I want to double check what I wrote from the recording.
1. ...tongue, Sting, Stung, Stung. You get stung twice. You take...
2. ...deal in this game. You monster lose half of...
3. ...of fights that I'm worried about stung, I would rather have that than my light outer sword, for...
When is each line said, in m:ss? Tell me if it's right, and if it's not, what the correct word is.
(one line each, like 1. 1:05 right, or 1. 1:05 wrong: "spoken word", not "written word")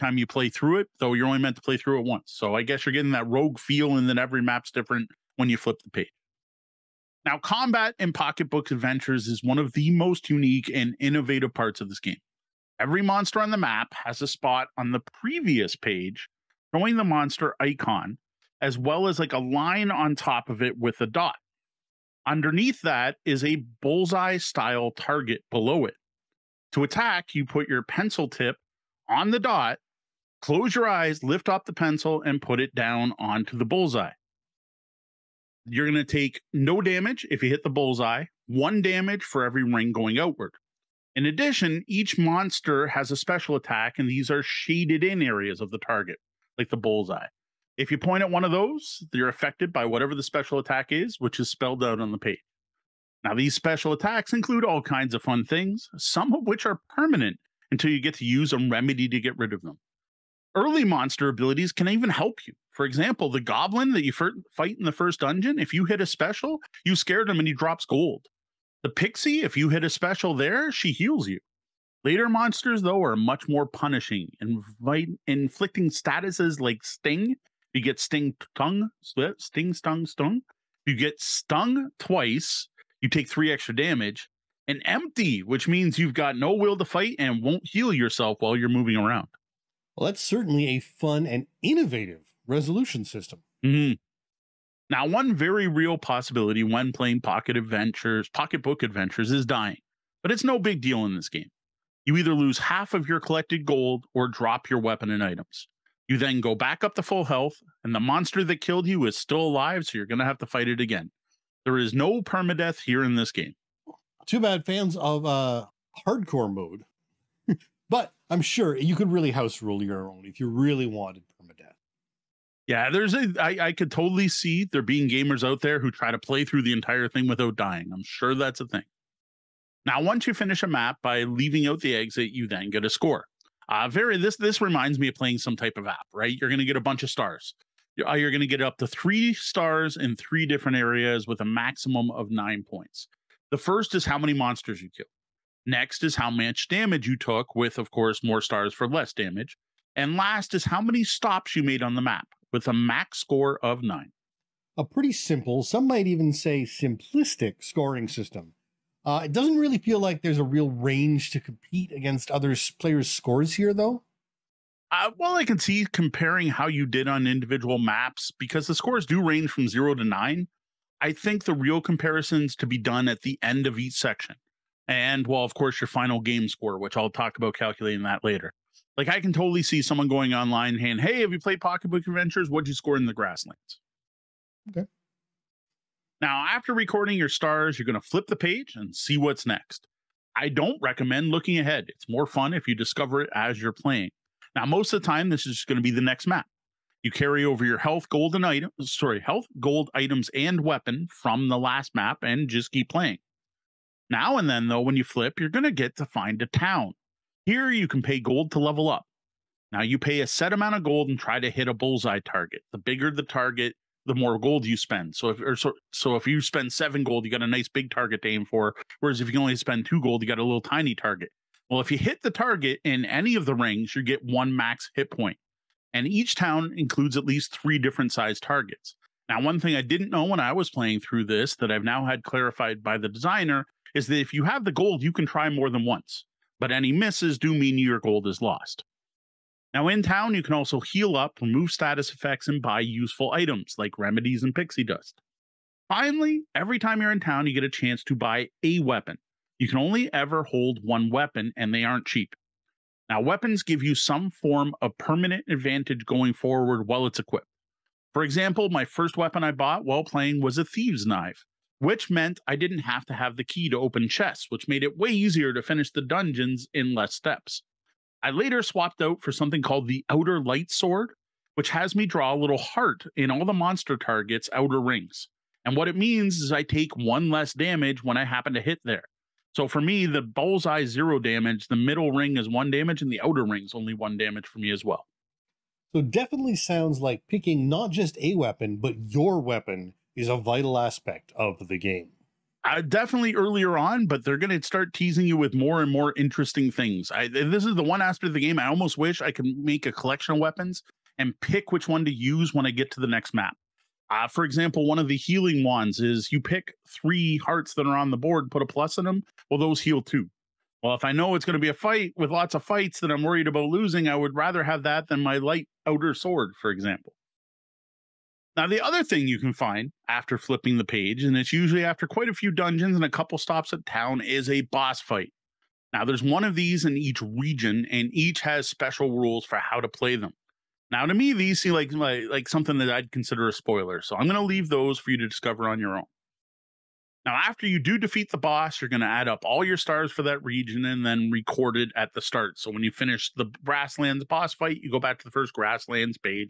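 1. 1:18 right
2. 1:40 wrong: "either", not "monster"
3. 5:12 wrong: "losing", not "stung".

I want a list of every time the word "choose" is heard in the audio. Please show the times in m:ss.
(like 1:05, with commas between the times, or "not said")
not said.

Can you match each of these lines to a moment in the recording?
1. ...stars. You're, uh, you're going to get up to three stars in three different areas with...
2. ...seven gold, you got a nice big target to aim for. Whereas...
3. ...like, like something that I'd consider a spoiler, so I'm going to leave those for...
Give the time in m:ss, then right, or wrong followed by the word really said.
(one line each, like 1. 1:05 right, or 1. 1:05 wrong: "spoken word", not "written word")
1. 2:17 right
2. 3:36 right
3. 5:31 right.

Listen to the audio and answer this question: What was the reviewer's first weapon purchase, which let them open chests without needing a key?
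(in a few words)
Thieves knife.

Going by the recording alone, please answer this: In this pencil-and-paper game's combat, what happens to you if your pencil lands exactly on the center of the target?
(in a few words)
No damage.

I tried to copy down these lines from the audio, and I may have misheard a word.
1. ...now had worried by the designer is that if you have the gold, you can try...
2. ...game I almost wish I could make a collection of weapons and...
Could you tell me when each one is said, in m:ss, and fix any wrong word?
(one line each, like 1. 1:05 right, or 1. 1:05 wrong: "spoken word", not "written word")
1. 3:51 wrong: "clarified", not "worried"
2. 4:58 right.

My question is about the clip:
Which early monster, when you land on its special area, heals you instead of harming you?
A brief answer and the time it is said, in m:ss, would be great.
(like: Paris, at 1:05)
The pixie, at 1:08.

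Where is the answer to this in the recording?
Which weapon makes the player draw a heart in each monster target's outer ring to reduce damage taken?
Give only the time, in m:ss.
4:30.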